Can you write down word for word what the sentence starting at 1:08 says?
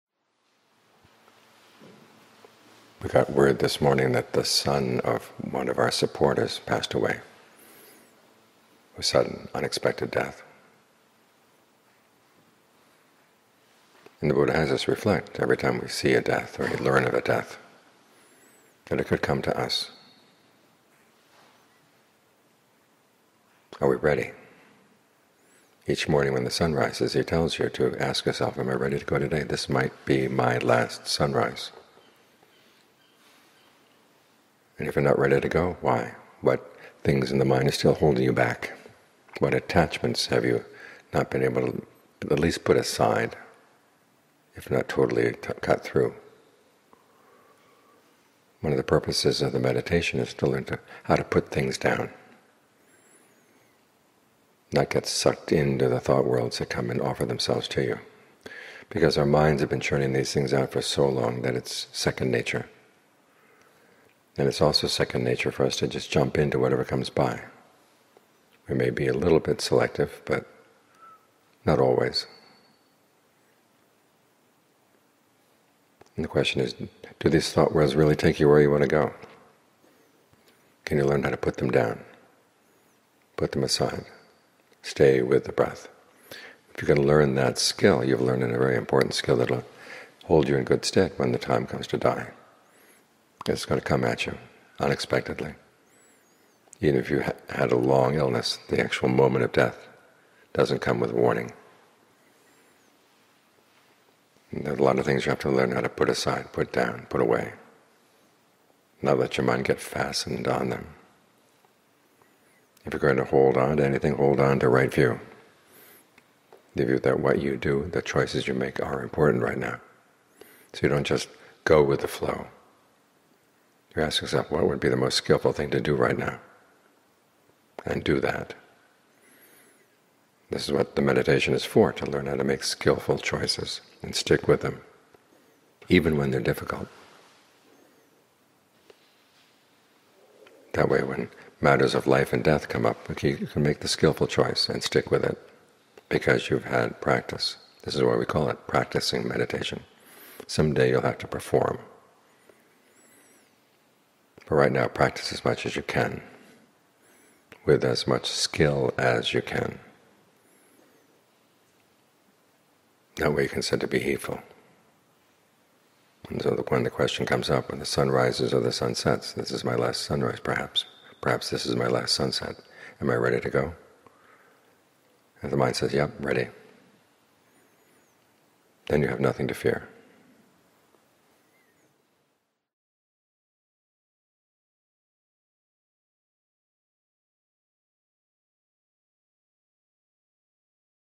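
We may be a little bit selective, but not always.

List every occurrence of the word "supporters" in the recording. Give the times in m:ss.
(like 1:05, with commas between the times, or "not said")
0:05.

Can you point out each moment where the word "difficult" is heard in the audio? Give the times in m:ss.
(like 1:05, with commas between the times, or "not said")
2:16.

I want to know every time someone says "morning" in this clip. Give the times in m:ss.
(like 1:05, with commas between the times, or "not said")
0:03, 0:26.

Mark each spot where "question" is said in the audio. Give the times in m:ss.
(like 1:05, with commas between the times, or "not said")
1:16, 2:46.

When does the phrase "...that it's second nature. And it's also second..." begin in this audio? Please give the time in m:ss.
1:01.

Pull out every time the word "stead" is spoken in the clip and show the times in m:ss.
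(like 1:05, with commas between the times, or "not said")
1:30.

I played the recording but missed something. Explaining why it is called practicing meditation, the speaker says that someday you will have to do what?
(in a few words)
perform.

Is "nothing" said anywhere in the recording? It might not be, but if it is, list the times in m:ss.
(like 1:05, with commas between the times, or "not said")
2:59.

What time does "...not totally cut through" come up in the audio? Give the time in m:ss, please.
0:44.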